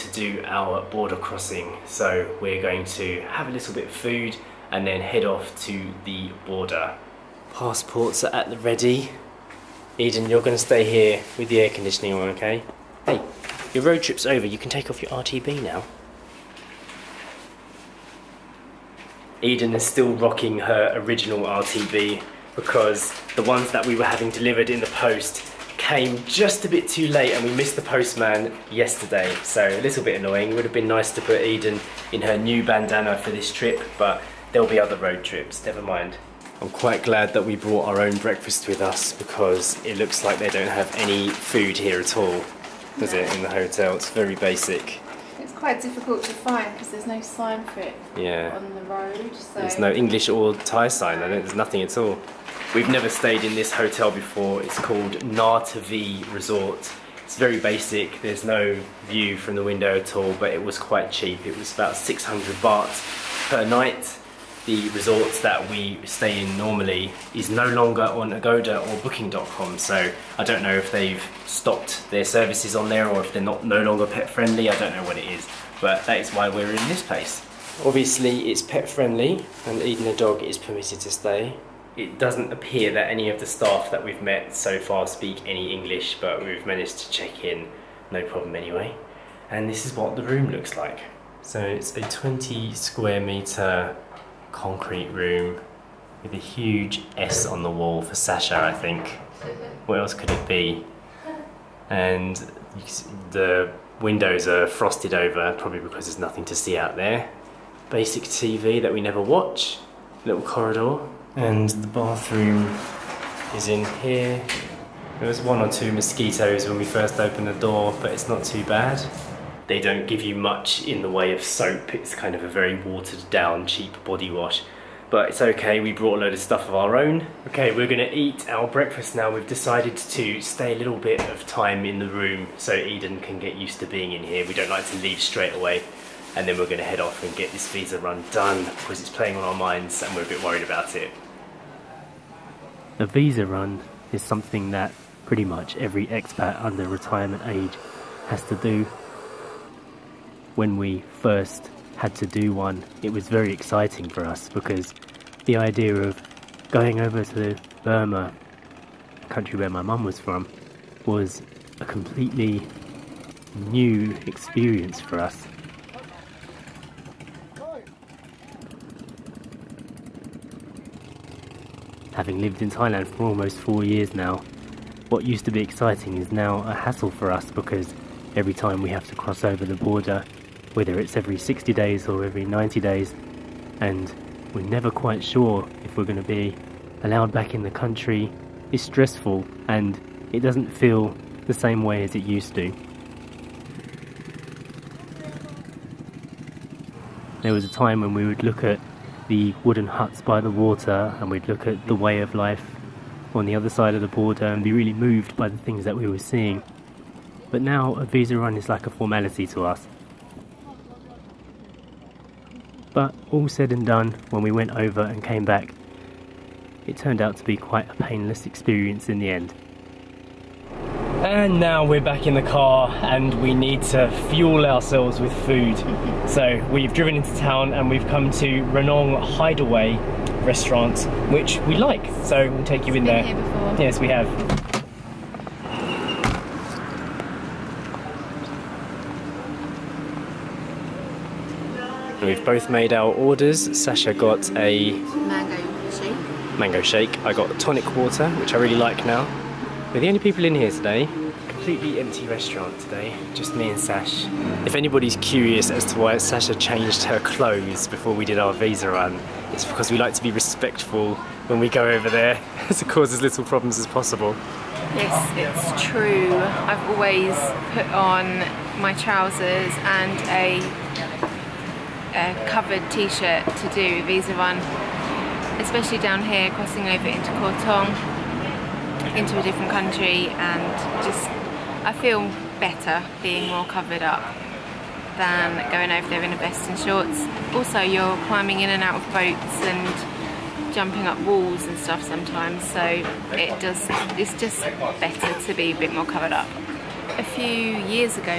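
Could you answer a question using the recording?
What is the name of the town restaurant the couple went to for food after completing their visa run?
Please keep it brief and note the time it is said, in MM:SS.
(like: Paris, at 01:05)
Ranong Hideaway, at 03:48.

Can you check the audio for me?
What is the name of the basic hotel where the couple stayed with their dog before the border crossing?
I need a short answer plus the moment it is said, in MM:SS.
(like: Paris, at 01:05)
Nartavi Resort, at 00:55.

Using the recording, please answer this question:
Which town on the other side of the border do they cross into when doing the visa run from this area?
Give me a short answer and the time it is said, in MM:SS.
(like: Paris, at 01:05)
Kawthaung, at 04:37.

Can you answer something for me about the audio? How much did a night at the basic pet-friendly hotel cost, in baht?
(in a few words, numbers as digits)
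600.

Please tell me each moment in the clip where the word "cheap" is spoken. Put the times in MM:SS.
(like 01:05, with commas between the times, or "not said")
01:01, 02:03.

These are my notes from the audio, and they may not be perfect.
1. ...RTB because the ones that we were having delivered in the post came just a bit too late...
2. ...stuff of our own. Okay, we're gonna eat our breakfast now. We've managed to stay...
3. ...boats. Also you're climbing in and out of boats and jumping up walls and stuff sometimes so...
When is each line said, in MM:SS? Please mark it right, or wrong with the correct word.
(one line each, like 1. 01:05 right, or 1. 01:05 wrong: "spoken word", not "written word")
1. 00:21 right
2. 02:06 wrong: "decided", not "managed"
3. 04:46 wrong: "shorts", not "boats".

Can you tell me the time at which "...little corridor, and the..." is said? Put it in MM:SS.
01:50.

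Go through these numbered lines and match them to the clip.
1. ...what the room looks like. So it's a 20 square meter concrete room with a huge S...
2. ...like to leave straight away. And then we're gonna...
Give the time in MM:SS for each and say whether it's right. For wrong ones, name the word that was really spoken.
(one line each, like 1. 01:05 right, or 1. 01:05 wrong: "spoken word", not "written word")
1. 01:29 right
2. 02:14 right.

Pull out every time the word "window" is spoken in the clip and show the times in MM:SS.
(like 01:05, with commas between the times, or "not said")
00:59, 01:44.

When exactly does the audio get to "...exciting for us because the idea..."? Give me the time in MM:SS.
02:33.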